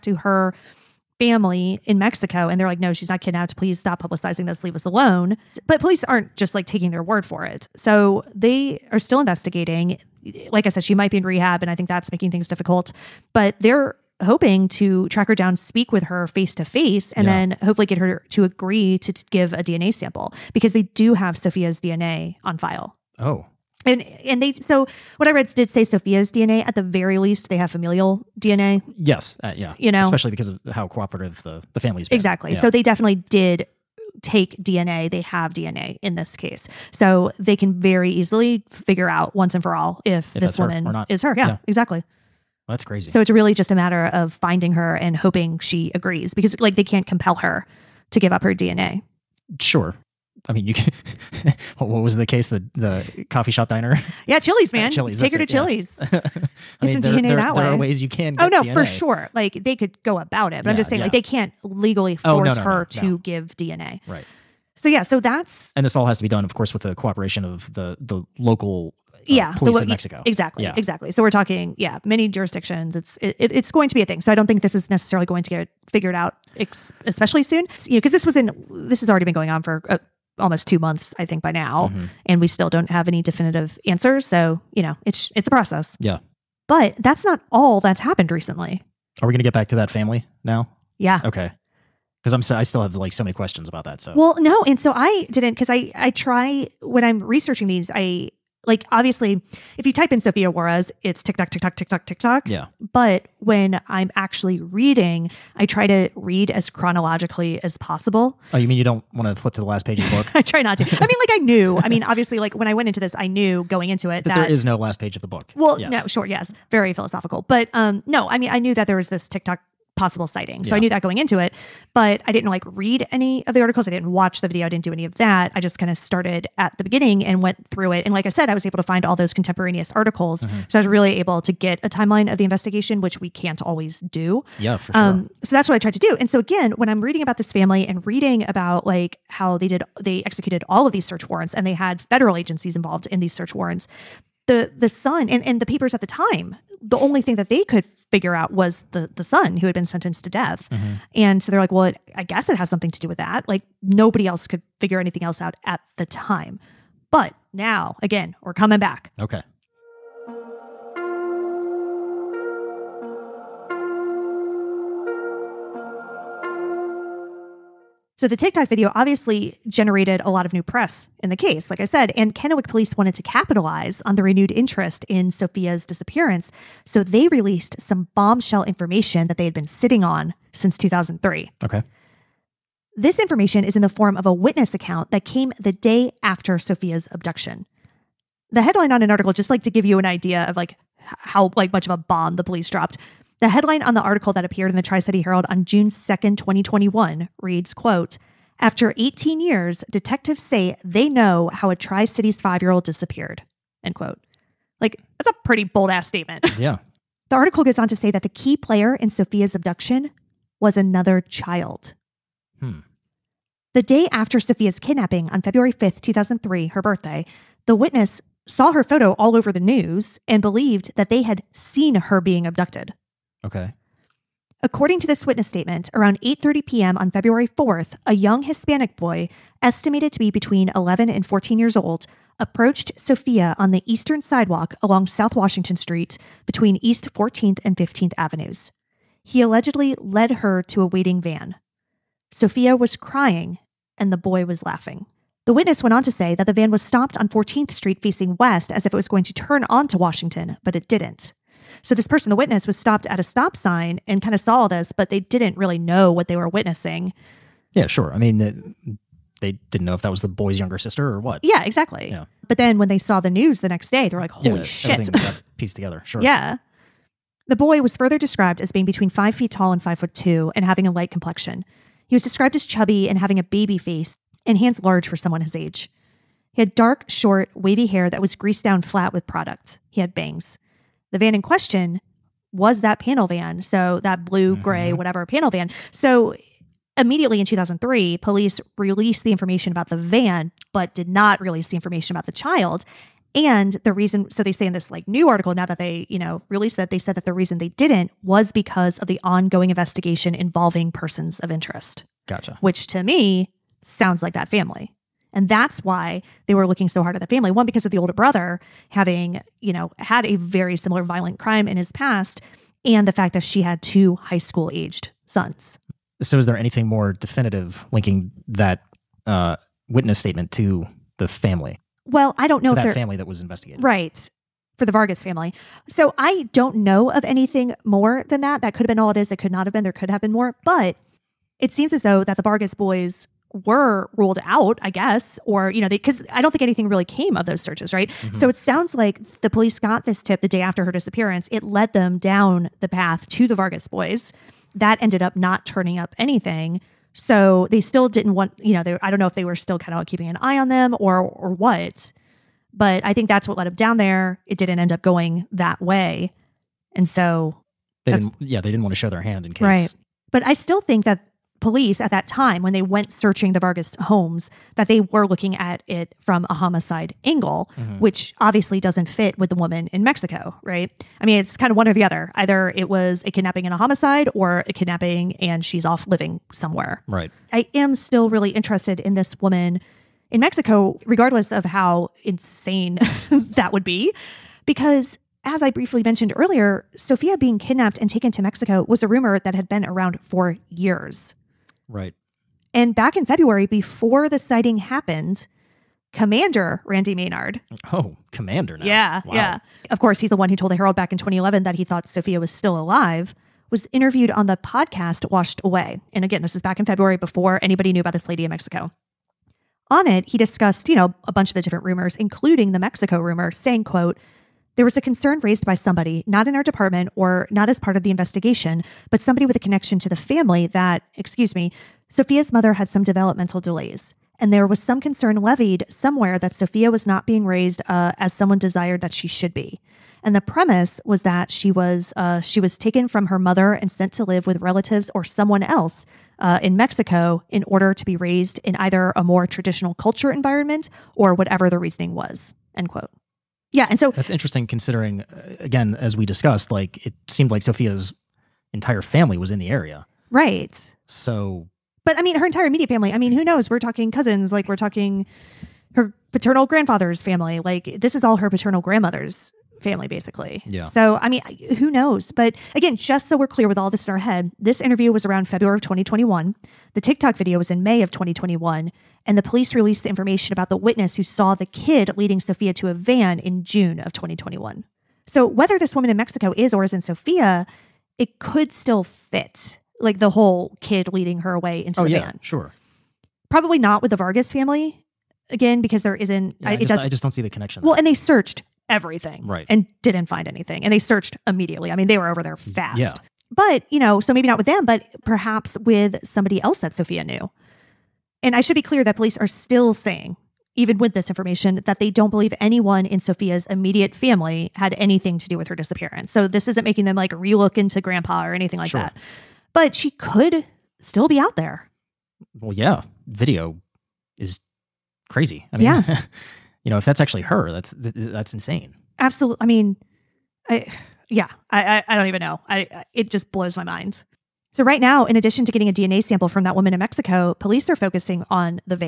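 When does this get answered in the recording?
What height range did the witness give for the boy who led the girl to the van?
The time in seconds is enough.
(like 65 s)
269 s.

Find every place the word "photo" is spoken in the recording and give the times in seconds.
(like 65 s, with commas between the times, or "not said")
218 s.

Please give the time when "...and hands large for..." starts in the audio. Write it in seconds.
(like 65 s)
274 s.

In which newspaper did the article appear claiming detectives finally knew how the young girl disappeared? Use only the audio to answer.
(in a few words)
Tri-City Herald.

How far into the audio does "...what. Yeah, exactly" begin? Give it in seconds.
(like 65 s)
261 s.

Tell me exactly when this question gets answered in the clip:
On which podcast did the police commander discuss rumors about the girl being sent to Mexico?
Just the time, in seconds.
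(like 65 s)
405 s.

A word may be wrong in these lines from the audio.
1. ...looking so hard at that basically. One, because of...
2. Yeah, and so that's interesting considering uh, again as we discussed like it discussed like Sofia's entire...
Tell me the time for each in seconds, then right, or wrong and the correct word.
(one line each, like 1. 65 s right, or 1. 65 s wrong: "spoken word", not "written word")
1. 306 s wrong: "family", not "basically"
2. 443 s wrong: "seemed", not "discussed".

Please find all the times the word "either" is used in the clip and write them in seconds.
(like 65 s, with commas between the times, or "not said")
372 s, 438 s.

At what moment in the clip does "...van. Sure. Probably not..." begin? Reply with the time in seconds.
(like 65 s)
482 s.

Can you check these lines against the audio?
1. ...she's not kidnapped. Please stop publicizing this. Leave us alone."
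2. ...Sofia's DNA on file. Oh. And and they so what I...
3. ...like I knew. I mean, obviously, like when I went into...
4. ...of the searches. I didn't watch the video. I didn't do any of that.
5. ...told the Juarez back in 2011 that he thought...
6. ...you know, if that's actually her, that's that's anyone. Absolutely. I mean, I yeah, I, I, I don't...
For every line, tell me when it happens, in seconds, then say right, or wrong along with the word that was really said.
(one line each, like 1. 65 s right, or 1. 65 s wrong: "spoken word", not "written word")
1. 2 s right
2. 21 s right
3. 111 s right
4. 123 s wrong: "articles", not "searches"
5. 400 s wrong: "Herald", not "Juarez"
6. 516 s wrong: "insane", not "anyone".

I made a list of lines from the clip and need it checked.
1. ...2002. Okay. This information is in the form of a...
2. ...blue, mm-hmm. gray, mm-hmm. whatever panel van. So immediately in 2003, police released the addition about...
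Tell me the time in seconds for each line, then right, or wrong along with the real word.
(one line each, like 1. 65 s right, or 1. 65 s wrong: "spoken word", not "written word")
1. 180 s wrong: "2003", not "2002"
2. 284 s wrong: "information", not "addition".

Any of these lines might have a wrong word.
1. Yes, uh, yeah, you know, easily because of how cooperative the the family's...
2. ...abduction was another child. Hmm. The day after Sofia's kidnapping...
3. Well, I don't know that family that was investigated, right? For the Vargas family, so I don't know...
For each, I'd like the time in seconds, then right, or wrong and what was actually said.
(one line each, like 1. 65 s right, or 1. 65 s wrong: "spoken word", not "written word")
1. 28 s wrong: "especially", not "easily"
2. 209 s right
3. 322 s right.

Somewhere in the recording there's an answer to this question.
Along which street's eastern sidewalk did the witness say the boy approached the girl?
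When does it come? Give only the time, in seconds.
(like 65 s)
235 s.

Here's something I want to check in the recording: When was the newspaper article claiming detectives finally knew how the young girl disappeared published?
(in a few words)
June 2nd, 2021.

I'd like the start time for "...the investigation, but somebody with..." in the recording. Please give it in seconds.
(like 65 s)
418 s.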